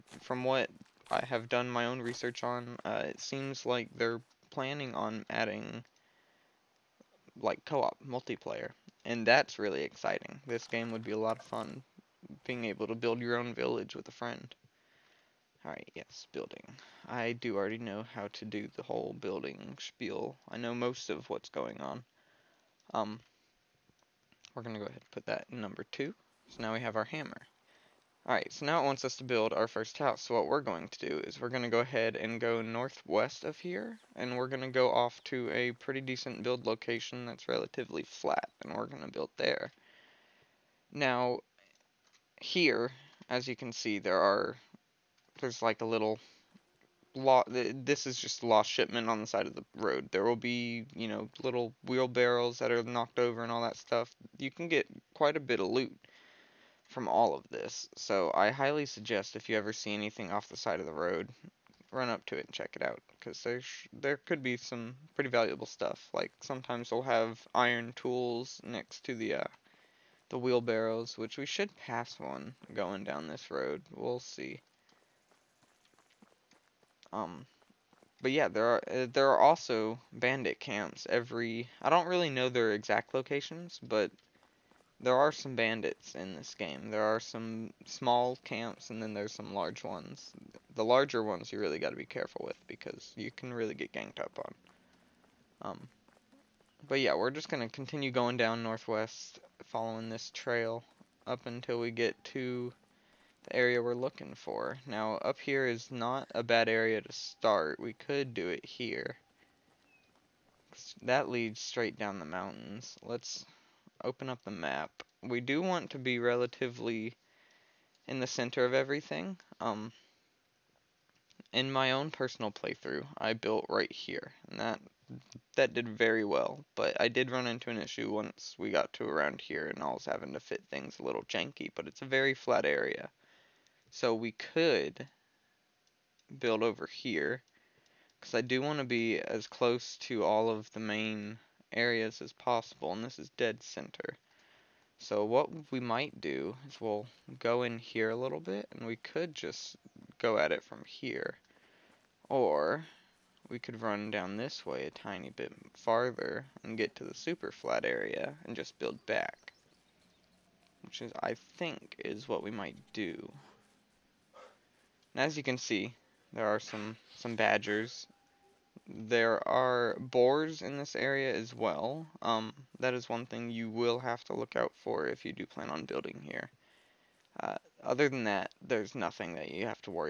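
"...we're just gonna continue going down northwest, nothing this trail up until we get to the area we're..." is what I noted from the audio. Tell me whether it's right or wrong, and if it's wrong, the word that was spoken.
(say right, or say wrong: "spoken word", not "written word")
wrong: "following", not "nothing".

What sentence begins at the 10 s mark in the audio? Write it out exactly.
This game would be a lot of fun, being able to build your own village with a friend.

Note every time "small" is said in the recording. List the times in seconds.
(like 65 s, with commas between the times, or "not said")
87 s.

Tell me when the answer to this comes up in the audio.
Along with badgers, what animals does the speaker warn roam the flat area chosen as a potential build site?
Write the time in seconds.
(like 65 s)
169 s.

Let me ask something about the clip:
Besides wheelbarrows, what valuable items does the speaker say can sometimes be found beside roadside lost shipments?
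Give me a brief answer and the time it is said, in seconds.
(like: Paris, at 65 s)
Iron tools, at 67 s.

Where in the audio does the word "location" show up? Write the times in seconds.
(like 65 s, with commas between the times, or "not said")
36 s, 83 s.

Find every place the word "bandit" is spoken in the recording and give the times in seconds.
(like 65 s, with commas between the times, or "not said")
80 s, 85 s.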